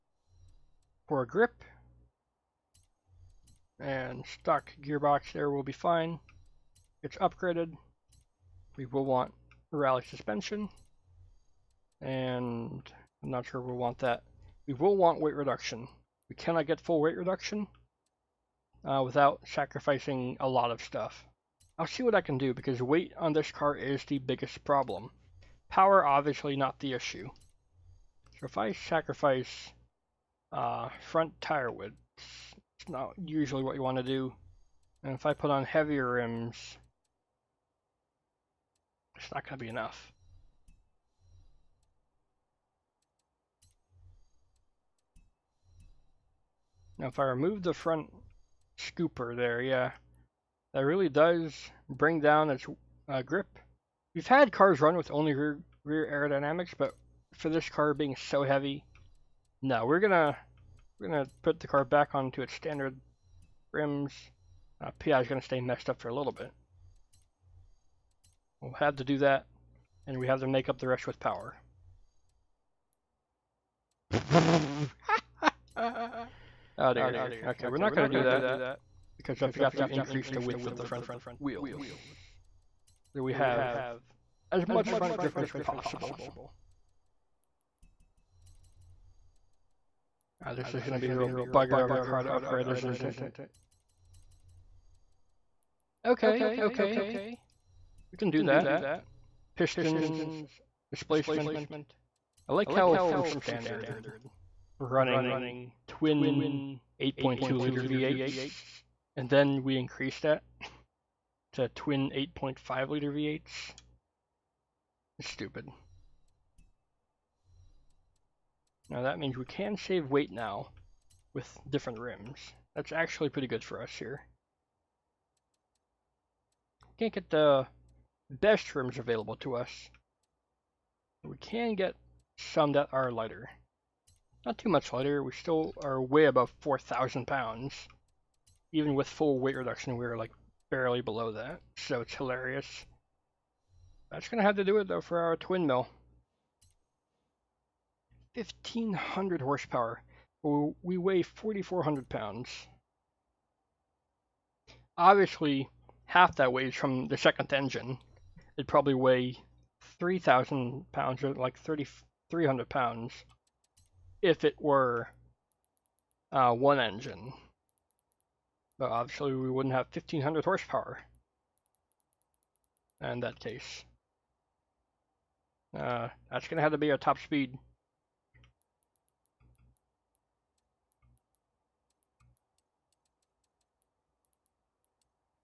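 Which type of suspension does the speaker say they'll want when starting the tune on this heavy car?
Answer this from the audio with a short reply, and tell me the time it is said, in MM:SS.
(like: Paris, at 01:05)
rally suspension, at 00:09.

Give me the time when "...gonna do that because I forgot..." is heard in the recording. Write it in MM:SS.
01:17.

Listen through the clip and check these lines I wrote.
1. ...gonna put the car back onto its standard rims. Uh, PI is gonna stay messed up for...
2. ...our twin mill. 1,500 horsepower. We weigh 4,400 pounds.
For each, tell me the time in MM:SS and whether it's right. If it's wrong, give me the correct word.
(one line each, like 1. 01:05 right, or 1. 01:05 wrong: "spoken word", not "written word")
1. 01:01 right
2. 02:25 right.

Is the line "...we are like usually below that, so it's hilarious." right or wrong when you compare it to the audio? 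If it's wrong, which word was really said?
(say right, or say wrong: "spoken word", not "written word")
wrong: "barely", not "usually".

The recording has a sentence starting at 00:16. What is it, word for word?
We cannot get full weight reduction uh, without sacrificing a lot of stuff.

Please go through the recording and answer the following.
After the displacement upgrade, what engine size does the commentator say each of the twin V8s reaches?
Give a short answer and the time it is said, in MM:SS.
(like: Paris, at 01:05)
8.5 liter, at 01:52.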